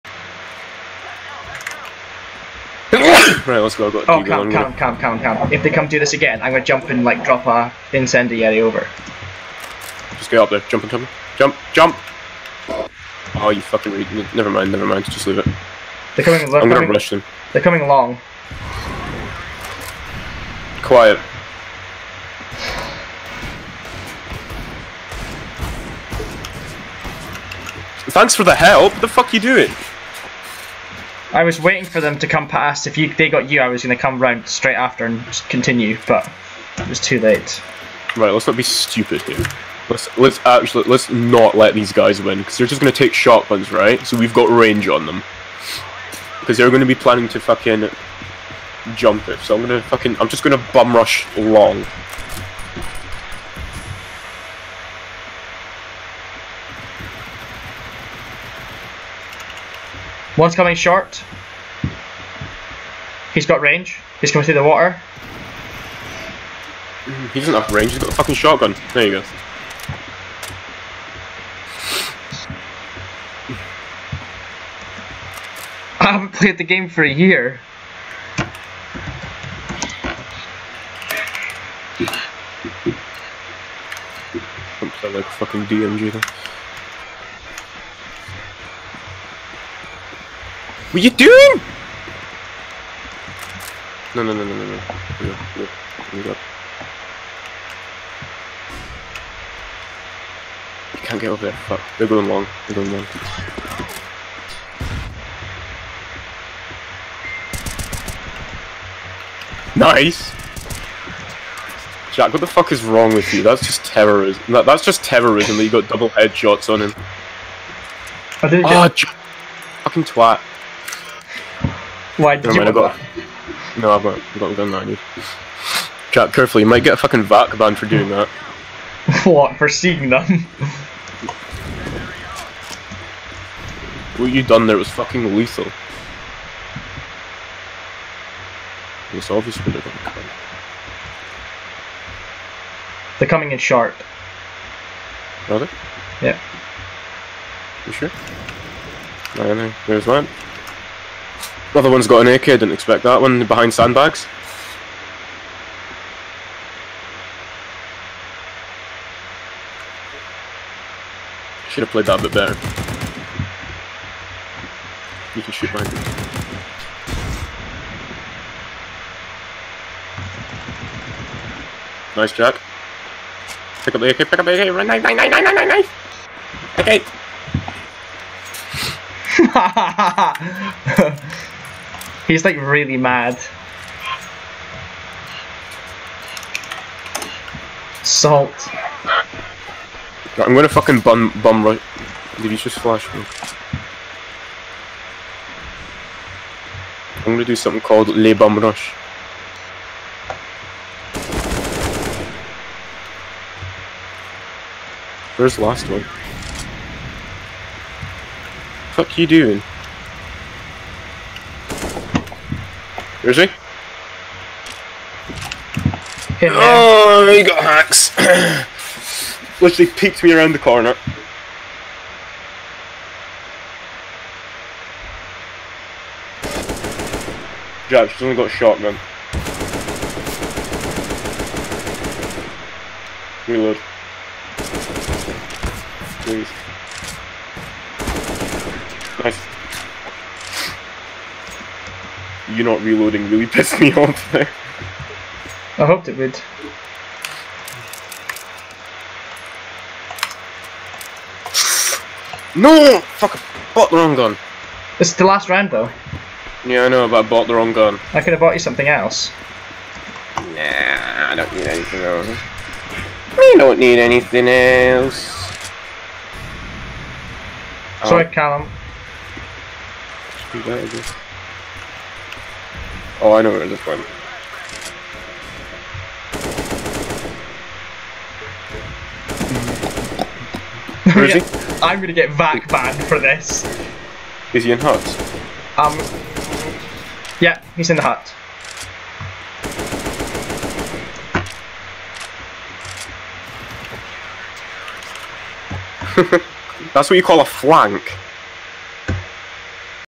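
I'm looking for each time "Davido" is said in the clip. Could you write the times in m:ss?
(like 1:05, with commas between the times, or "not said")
not said.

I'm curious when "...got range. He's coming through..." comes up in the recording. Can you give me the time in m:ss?
1:03.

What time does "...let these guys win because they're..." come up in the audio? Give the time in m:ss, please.
0:41.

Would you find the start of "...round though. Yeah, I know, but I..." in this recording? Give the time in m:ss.
4:15.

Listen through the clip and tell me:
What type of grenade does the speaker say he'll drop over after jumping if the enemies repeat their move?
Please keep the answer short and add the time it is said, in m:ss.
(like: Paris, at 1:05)
Incendiary, at 0:07.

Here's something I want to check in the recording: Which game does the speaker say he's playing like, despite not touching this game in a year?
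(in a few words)
DMG.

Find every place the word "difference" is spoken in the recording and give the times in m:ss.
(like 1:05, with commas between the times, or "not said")
not said.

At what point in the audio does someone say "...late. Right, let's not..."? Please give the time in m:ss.
0:37.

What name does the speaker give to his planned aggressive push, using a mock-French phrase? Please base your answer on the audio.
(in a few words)
Le Bum Rush.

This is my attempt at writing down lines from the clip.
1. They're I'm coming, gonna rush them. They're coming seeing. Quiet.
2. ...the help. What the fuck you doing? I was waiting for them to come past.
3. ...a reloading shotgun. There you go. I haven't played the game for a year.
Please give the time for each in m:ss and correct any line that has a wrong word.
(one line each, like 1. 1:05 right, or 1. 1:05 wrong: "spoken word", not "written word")
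1. 0:16 wrong: "along", not "seeing"
2. 0:28 right
3. 1:08 wrong: "fucking", not "reloading".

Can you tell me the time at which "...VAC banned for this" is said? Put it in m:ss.
4:42.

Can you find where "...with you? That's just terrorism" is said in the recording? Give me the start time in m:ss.
1:53.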